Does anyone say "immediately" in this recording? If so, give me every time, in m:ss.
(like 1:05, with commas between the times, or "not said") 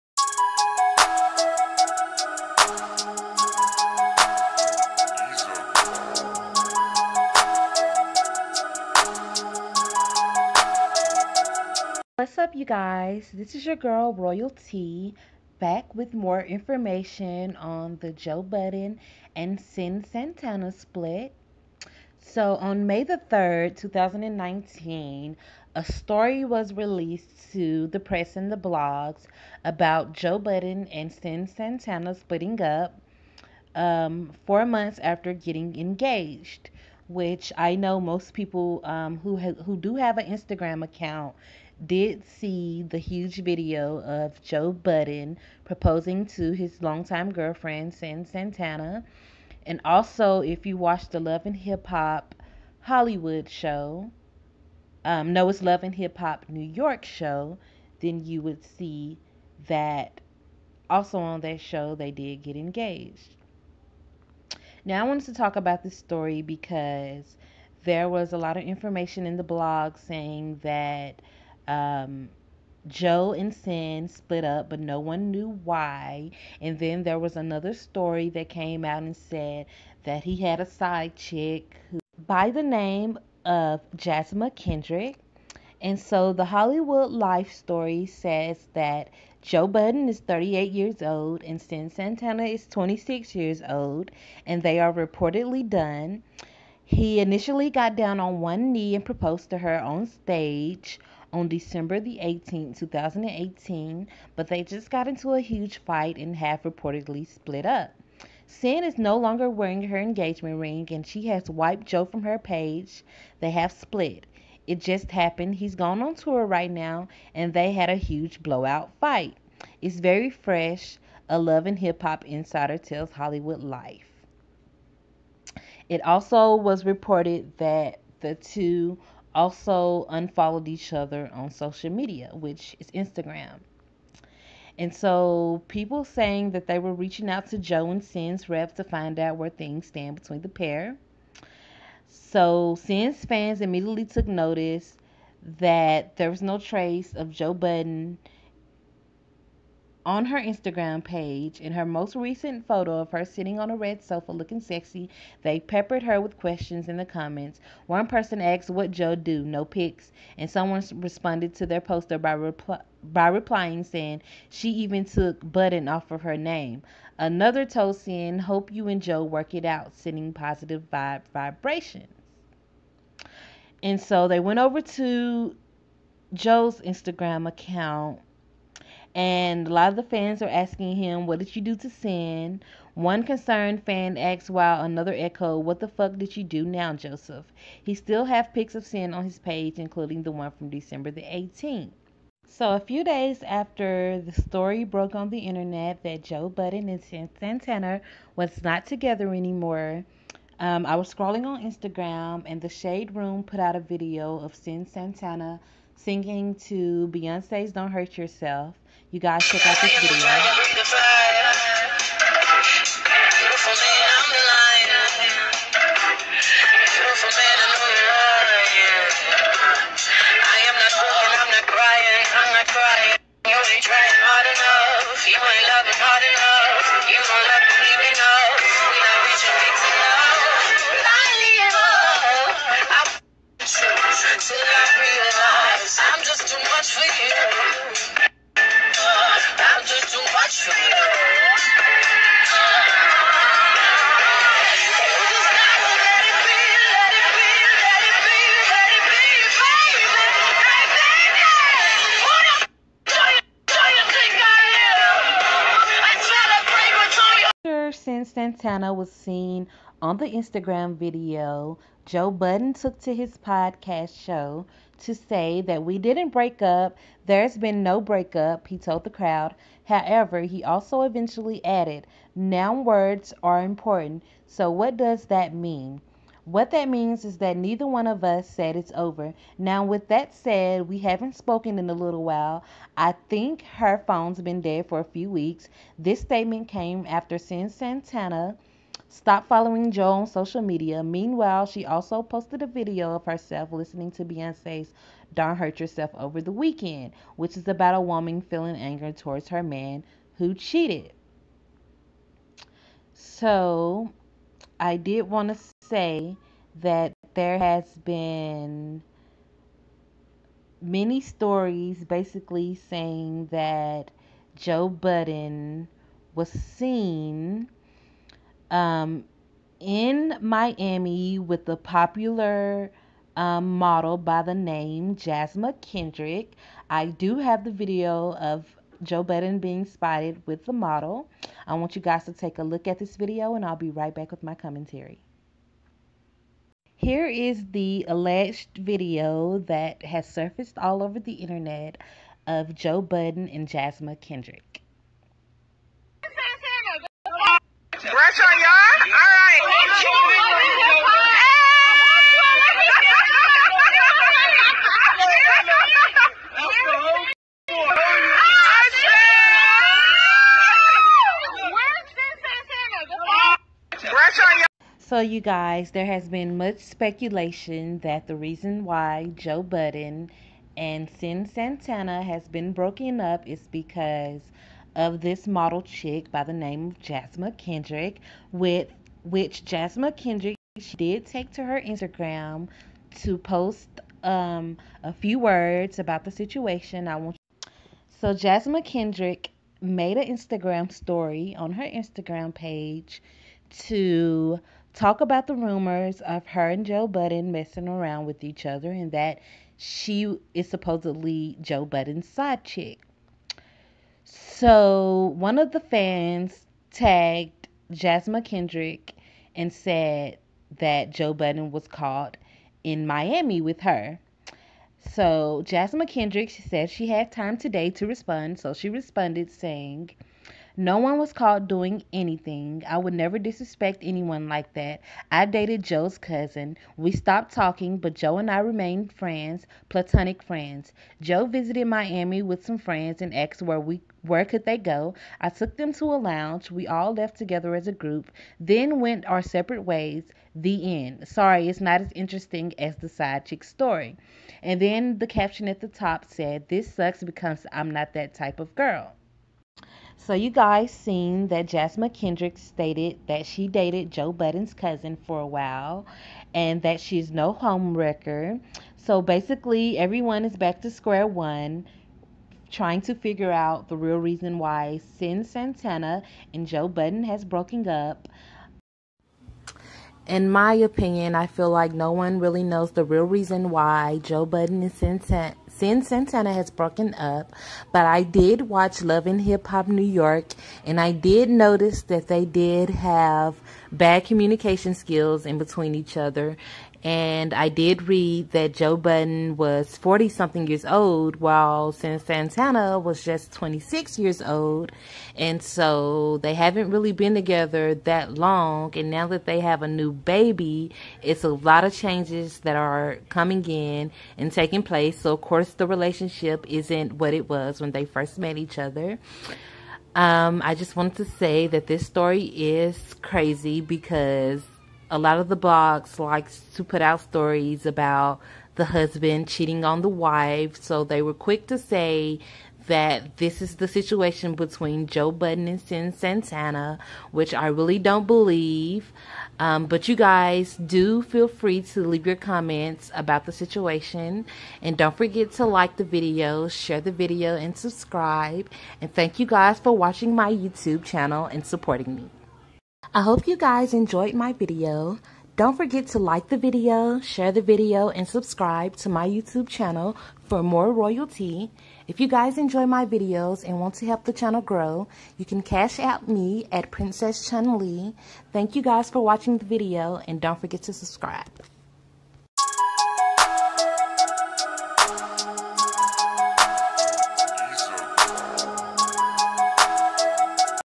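2:23.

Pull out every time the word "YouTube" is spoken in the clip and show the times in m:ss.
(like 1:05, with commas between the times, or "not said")
9:00, 9:09.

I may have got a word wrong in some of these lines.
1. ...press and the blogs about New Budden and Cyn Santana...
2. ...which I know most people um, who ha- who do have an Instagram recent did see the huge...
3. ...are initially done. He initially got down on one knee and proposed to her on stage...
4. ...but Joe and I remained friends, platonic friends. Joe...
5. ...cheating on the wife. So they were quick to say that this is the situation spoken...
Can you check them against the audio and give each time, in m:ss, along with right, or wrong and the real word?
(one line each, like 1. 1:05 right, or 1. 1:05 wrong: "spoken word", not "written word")
1. 0:28 wrong: "Joe", not "New"
2. 0:37 wrong: "account", not "recent"
3. 1:34 wrong: "reportedly", not "initially"
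4. 7:07 right
5. 8:39 wrong: "between", not "spoken".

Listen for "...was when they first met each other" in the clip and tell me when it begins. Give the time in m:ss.
8:27.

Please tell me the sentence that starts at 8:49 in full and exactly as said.
Um, but you guys do feel free to leave your comments about the situation.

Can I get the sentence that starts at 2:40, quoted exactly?
And someone responded to their poster by, by replying, saying, She even took Budden off of her name.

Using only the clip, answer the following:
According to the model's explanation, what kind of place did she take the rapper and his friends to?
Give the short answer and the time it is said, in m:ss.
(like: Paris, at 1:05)
A lounge, at 7:16.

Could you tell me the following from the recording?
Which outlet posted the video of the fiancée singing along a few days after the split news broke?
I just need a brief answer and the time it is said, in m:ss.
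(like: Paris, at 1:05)
The Shade Room, at 3:22.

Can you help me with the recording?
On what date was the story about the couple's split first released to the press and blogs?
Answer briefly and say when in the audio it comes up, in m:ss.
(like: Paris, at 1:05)
May 3, 2019, at 0:22.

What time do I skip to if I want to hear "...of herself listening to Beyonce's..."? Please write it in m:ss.
4:53.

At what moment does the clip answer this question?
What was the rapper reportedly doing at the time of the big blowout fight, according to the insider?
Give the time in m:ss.
1:56.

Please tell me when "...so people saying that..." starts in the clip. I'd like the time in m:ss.
2:14.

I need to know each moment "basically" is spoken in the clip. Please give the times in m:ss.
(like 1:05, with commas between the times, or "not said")
5:12, 7:39.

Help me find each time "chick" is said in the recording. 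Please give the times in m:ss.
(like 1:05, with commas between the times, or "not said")
1:21, 6:15, 6:42, 7:23.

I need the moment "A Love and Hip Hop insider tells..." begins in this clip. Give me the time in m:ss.
2:01.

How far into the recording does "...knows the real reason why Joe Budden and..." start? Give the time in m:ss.
7:52.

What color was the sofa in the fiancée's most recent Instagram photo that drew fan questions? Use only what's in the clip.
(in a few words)
Red.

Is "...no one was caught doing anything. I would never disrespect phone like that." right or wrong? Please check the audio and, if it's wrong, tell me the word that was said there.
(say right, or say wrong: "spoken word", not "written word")
wrong: "anyone", not "phone".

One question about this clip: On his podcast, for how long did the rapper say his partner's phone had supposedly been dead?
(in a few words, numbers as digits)
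A few weeks.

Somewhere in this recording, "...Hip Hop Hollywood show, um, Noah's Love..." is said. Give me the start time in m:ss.
0:51.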